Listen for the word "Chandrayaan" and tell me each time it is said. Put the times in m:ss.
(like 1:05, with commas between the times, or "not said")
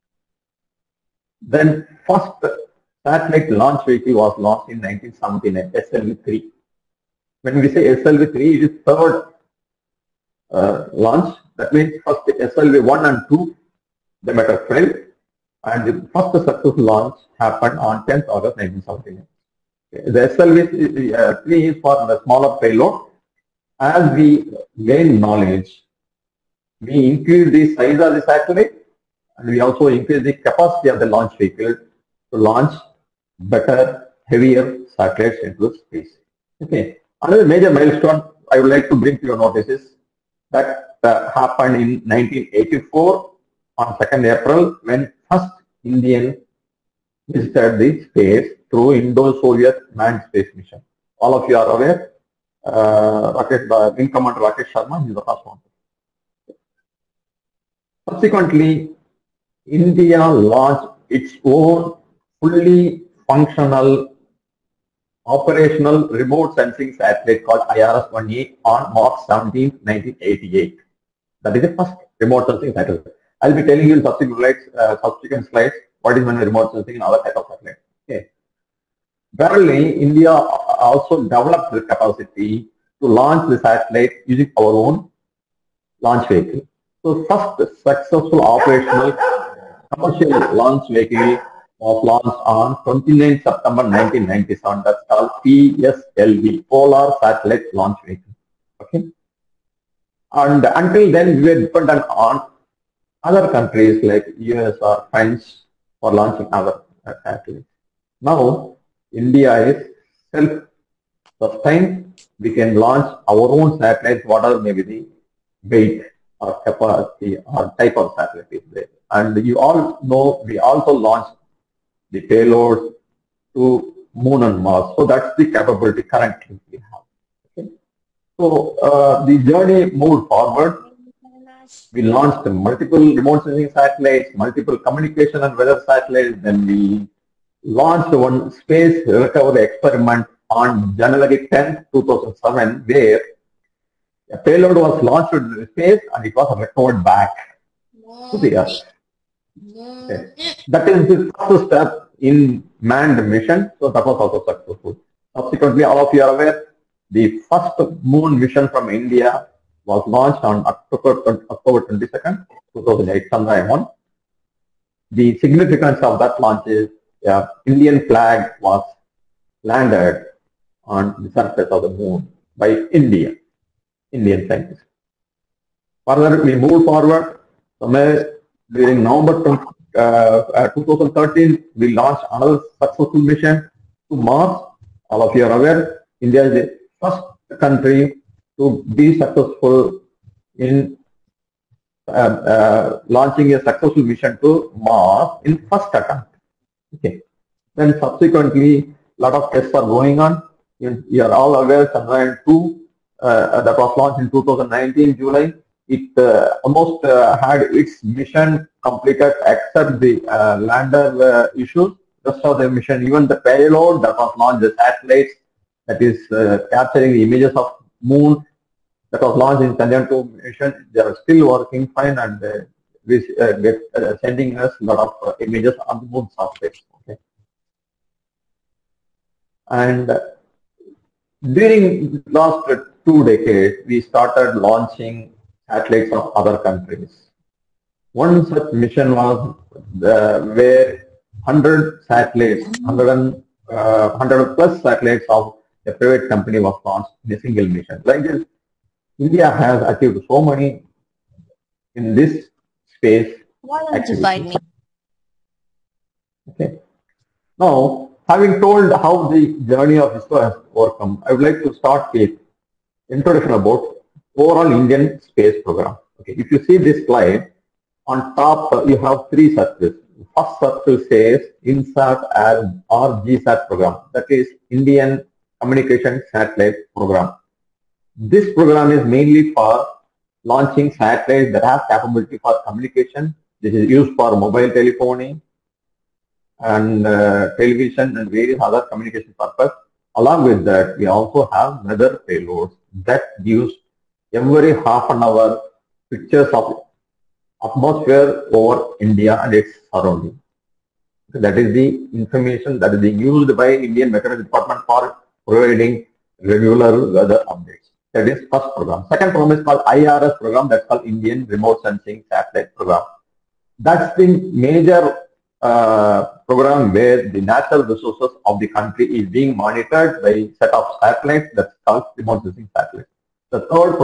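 3:21, 3:39.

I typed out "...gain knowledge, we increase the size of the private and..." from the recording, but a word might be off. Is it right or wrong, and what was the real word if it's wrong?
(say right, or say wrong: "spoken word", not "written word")
wrong: "satellite", not "private".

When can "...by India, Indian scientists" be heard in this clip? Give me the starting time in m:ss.
2:52.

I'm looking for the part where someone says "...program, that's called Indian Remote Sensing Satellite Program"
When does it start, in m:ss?
5:10.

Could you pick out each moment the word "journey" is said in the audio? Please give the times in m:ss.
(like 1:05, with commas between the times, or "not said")
2:09, 4:19.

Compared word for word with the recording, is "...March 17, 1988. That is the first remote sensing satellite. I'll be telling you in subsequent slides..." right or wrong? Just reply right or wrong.
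right.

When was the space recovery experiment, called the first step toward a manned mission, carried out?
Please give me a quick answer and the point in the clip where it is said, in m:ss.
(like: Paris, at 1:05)
January 10, 2007, at 2:20.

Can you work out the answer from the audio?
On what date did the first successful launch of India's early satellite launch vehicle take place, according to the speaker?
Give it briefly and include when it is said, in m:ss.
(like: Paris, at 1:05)
10 August 1979, at 0:18.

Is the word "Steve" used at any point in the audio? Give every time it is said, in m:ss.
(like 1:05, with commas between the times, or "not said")
not said.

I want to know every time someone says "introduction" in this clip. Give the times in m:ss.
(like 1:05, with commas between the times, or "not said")
4:23.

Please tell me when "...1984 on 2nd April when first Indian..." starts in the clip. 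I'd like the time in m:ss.
0:42.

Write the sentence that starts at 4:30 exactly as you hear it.
First circle says INSAT as or GSAT program, that is Indian Communication Satellite Program.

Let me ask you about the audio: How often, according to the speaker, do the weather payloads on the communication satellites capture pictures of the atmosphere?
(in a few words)
every half an hour.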